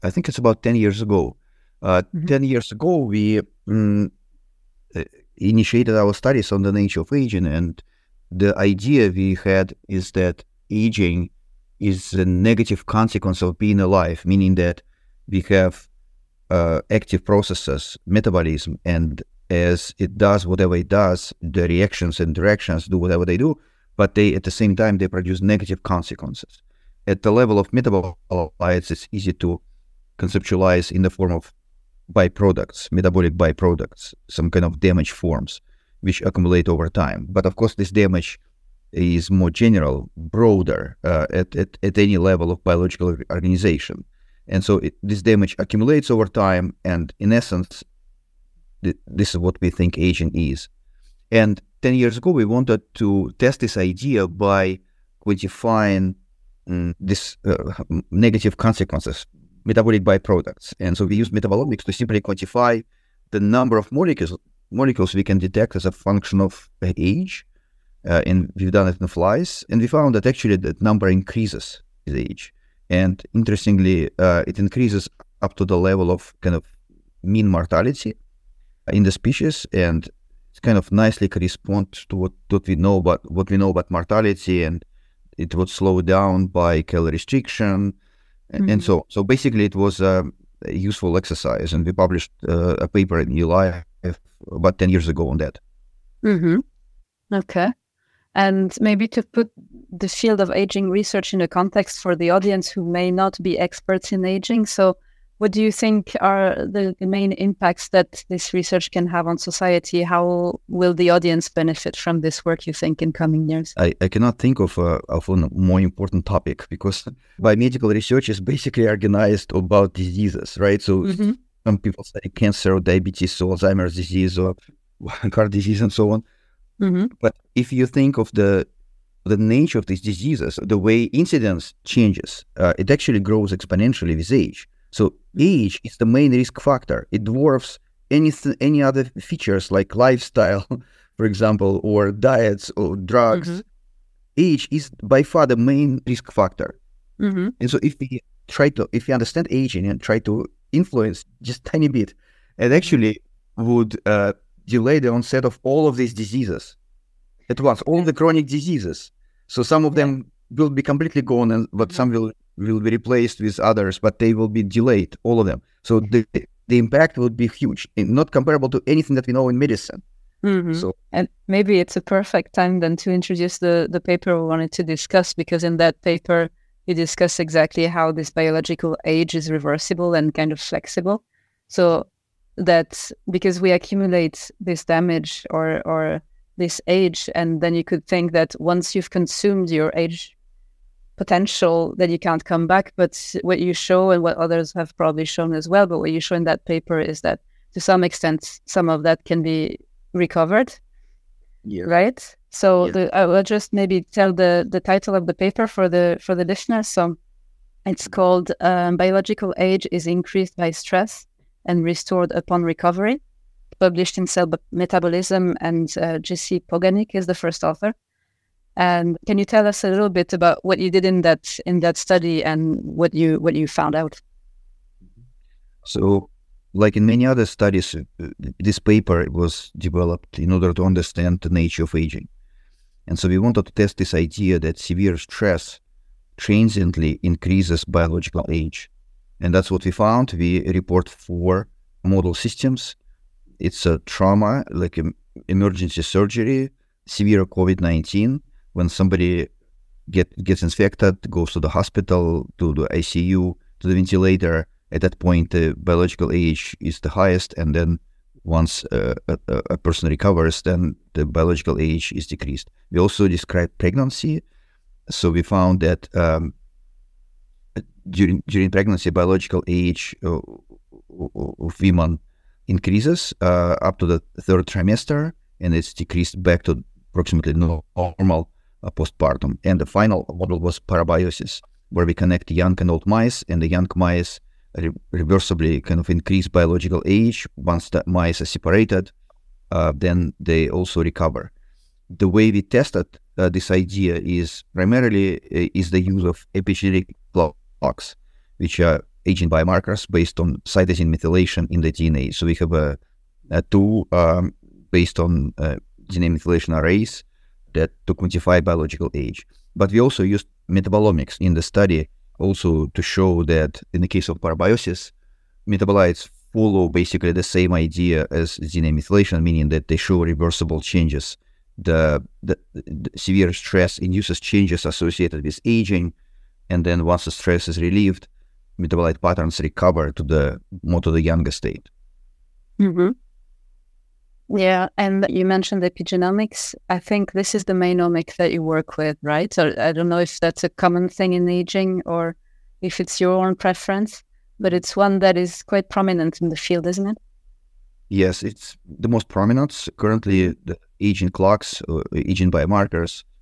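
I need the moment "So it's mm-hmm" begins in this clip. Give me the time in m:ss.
3:26.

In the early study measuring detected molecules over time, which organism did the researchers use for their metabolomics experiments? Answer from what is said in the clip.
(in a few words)
Flies.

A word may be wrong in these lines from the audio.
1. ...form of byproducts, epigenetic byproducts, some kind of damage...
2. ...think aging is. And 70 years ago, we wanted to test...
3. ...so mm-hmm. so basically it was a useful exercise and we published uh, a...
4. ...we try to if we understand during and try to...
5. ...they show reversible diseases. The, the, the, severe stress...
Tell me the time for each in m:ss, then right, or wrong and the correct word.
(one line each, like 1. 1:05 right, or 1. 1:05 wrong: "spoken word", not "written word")
1. 0:31 wrong: "metabolic", not "epigenetic"
2. 0:49 wrong: "10", not "70"
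3. 1:28 right
4. 2:27 wrong: "aging", not "during"
5. 5:19 wrong: "changes", not "diseases".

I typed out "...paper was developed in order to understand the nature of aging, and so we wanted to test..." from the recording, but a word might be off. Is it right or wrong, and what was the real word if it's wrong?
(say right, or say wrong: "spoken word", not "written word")
right.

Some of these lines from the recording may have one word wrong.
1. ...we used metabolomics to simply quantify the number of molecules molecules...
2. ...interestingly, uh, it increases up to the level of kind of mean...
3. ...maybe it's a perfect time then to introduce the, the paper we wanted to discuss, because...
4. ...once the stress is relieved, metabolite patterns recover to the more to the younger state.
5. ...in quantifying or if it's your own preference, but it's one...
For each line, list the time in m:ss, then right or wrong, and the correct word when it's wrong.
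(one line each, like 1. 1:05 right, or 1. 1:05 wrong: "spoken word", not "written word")
1. 1:01 right
2. 1:13 right
3. 2:51 right
4. 5:27 right
5. 5:41 wrong: "aging", not "quantifying".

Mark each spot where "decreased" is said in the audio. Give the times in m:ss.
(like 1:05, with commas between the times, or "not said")
4:22, 4:35.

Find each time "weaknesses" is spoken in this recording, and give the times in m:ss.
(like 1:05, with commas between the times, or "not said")
not said.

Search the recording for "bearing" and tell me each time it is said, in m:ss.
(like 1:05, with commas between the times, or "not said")
not said.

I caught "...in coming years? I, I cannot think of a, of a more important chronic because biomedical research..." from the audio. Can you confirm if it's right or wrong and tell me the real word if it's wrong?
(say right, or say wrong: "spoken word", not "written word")
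wrong: "topic", not "chronic".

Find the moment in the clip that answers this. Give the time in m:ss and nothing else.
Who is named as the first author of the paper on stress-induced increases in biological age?
3:36.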